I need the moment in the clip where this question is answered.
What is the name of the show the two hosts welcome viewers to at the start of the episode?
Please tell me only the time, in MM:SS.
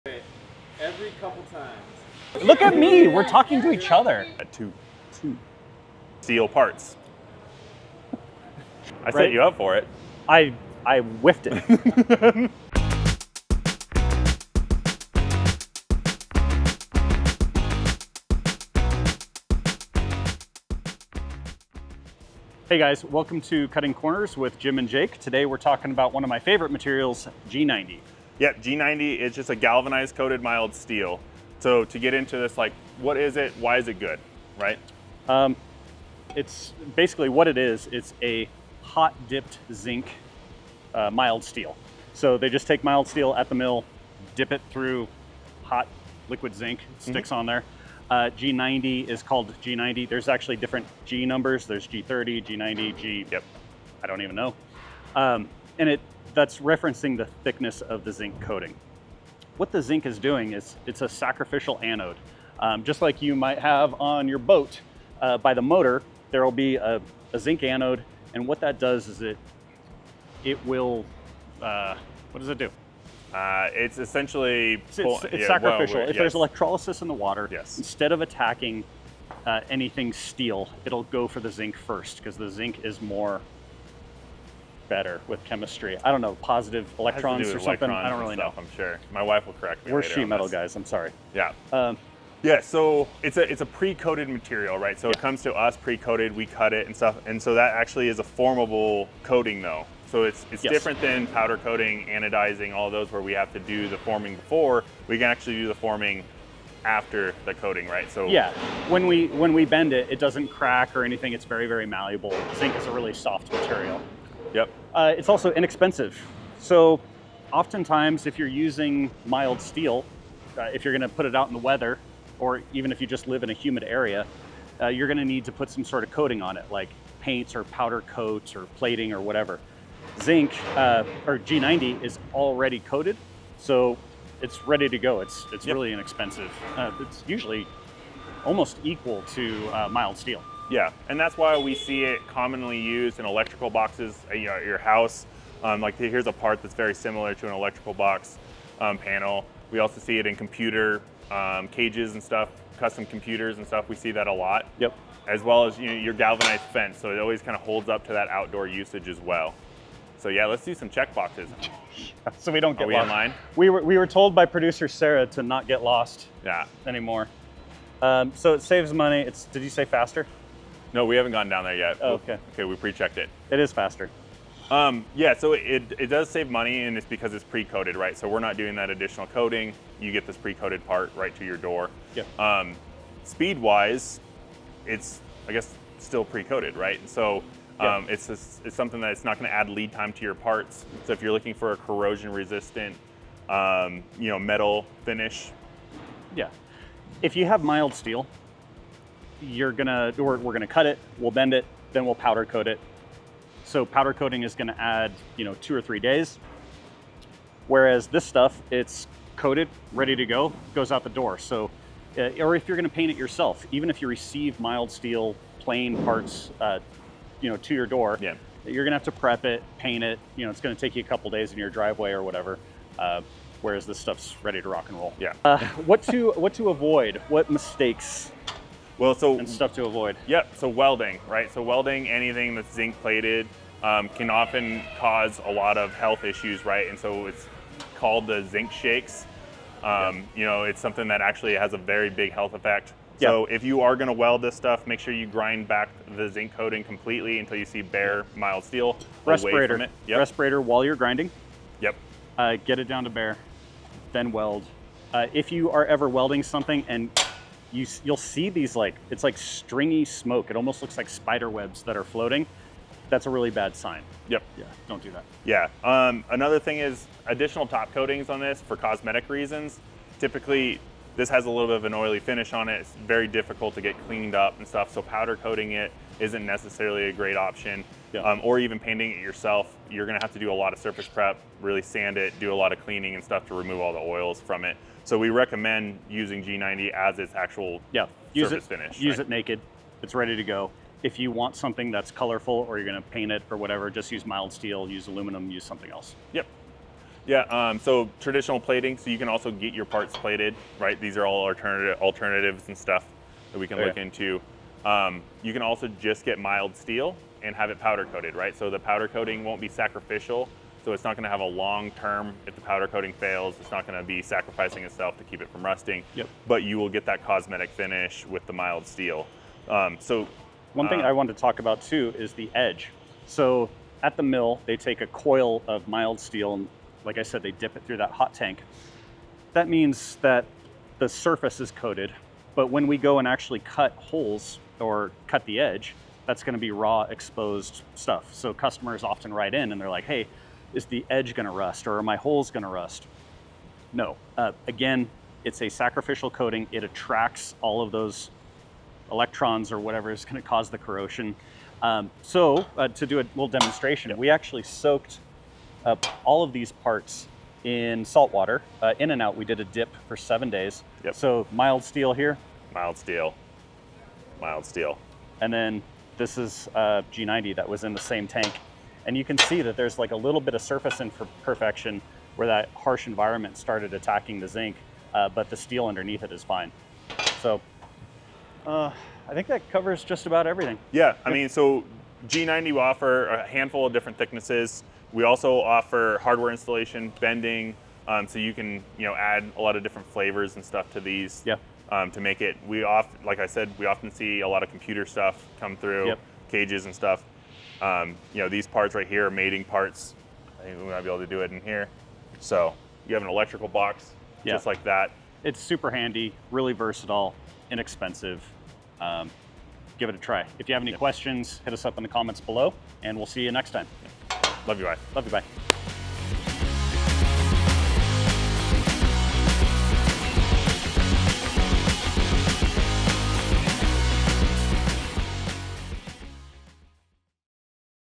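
00:23.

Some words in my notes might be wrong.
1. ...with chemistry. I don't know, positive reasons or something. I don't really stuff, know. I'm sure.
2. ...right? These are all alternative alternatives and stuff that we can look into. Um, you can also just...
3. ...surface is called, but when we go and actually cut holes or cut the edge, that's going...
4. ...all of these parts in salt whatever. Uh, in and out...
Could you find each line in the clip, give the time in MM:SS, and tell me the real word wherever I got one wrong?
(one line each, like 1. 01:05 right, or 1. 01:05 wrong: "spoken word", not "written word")
1. 01:25 wrong: "electrons", not "reasons"
2. 05:00 right
3. 05:31 wrong: "coated", not "called"
4. 05:56 wrong: "water", not "whatever".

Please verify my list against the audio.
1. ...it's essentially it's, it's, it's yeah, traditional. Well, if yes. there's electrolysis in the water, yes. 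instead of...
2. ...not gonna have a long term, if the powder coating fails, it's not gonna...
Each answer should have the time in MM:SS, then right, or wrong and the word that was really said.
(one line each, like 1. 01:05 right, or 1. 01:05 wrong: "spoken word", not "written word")
1. 01:13 wrong: "sacrificial", not "traditional"
2. 05:11 right.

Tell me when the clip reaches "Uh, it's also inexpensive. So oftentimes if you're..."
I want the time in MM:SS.
01:54.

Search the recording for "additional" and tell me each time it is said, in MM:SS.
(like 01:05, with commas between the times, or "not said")
02:58, 04:27.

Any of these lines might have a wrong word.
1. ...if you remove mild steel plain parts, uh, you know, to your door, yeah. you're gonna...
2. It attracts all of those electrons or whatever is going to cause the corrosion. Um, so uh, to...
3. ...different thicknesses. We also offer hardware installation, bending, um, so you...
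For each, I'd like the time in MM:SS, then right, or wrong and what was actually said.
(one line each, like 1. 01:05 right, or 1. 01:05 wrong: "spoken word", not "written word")
1. 03:33 wrong: "receive", not "remove"
2. 05:46 right
3. 06:23 right.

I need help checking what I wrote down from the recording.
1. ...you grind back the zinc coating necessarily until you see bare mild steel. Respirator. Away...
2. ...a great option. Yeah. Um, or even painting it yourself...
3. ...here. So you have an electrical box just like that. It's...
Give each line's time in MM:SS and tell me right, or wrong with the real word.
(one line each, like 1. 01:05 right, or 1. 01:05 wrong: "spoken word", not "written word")
1. 04:05 wrong: "completely", not "necessarily"
2. 04:37 right
3. 06:41 right.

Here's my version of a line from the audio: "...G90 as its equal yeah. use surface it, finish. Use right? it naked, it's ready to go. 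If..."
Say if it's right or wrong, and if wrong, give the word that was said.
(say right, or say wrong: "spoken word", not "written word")
wrong: "actual", not "equal".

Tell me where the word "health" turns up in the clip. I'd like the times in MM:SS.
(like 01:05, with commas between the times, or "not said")
03:55, 04:02.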